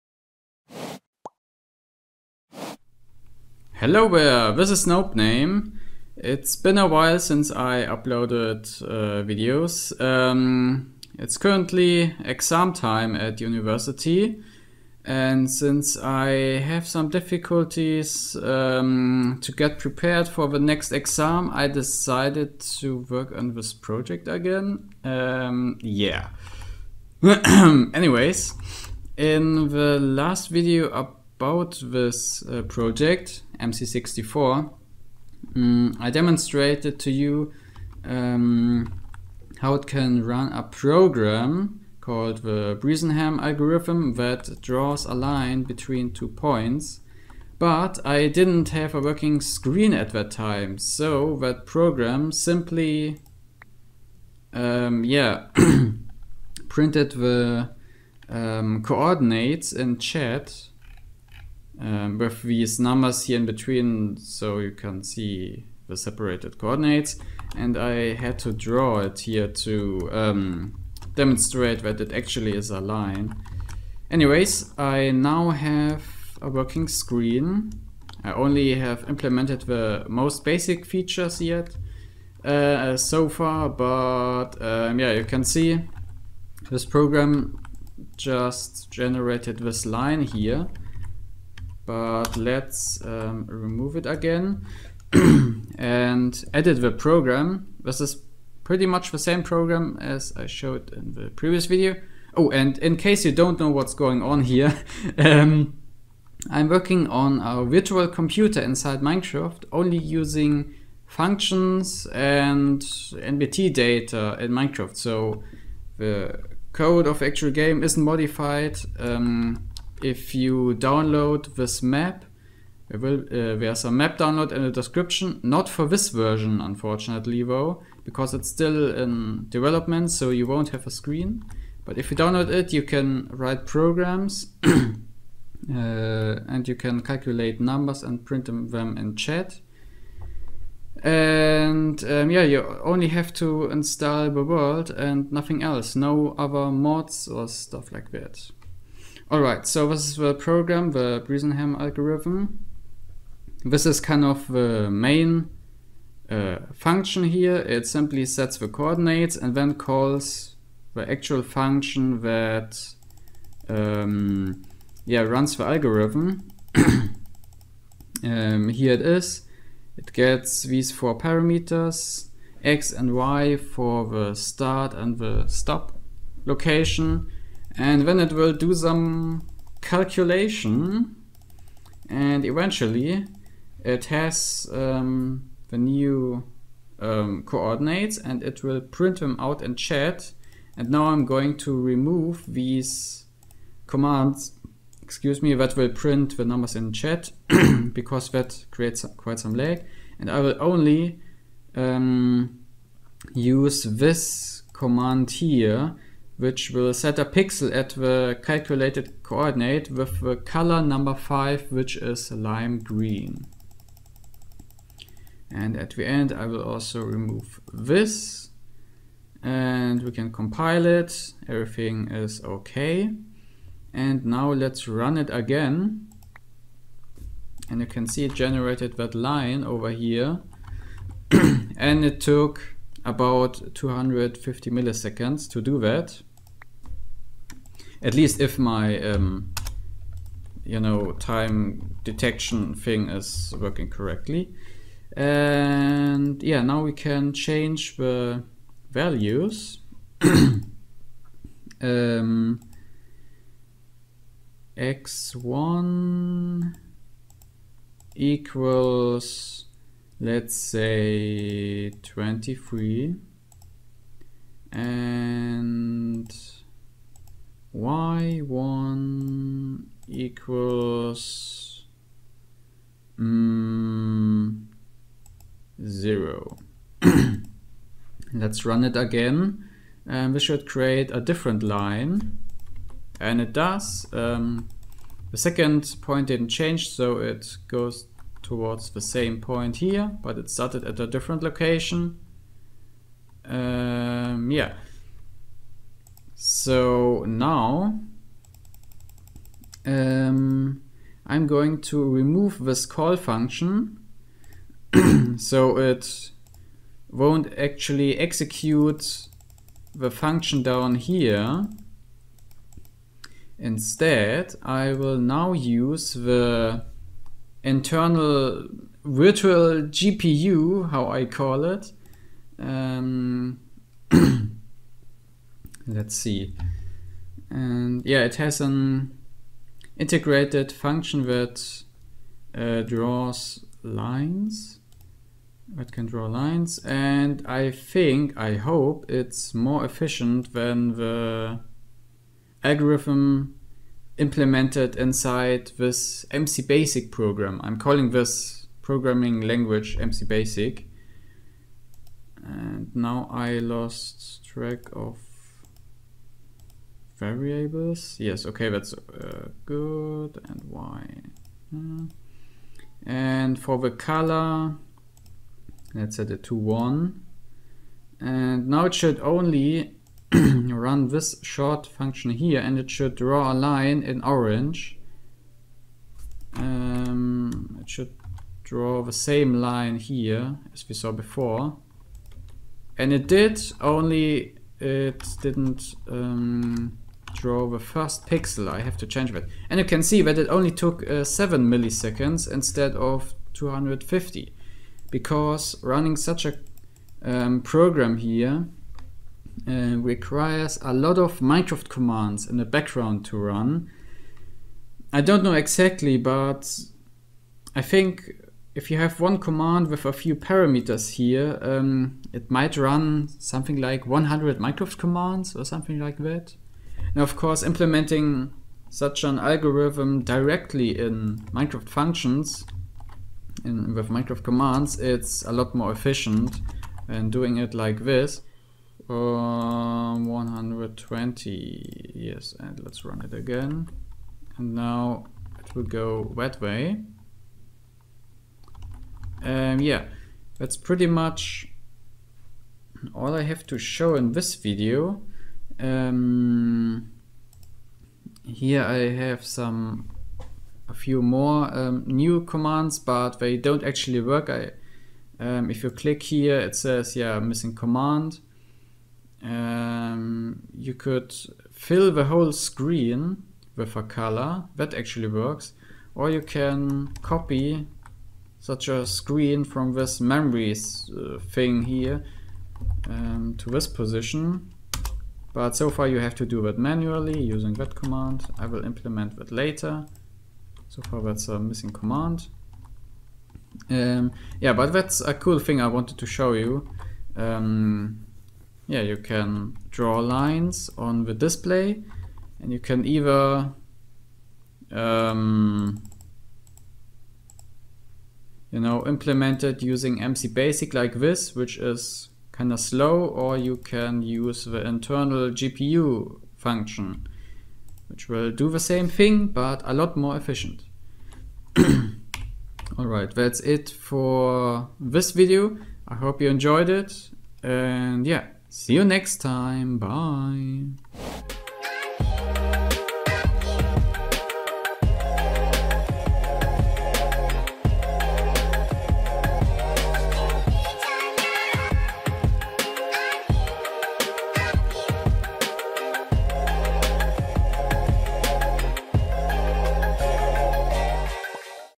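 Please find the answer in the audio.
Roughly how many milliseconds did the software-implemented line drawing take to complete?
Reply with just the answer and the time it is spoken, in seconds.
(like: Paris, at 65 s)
250, at 233 s.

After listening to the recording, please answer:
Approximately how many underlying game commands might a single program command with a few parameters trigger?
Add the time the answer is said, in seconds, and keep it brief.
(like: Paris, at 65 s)
100, at 414 s.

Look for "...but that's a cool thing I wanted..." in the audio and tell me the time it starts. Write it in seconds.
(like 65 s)
484 s.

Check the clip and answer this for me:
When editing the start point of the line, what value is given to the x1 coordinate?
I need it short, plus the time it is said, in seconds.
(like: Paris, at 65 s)
23, at 261 s.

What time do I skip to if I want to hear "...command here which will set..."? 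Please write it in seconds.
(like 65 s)
204 s.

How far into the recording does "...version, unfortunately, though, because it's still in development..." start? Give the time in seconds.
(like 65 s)
126 s.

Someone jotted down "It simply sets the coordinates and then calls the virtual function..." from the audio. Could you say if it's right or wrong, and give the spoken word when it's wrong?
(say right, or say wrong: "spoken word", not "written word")
wrong: "actual", not "virtual".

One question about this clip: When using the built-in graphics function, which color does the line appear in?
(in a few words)
orange.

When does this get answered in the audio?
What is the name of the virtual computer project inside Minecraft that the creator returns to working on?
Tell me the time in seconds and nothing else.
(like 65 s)
33 s.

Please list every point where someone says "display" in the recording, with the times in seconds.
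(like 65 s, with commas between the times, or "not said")
491 s.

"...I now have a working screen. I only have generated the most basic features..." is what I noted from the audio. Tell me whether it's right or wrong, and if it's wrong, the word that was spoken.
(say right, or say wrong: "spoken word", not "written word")
wrong: "implemented", not "generated".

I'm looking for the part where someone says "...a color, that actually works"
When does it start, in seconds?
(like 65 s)
463 s.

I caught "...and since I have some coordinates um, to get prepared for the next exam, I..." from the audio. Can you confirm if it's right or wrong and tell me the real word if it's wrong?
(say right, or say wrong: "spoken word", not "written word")
wrong: "difficulties", not "coordinates".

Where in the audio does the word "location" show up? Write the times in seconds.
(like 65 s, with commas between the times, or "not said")
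176 s, 291 s.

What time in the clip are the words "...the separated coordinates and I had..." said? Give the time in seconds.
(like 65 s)
65 s.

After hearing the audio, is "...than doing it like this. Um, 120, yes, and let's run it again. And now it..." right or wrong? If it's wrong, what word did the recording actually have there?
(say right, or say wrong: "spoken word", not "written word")
right.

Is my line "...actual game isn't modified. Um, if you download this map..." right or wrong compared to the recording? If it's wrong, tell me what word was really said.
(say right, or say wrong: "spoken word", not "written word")
right.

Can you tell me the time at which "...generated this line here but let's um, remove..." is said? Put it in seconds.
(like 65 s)
88 s.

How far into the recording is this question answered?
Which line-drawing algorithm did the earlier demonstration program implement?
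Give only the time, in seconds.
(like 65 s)
42 s.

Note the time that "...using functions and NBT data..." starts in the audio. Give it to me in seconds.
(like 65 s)
109 s.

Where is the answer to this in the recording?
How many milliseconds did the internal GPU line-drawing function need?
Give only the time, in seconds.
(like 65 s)
391 s.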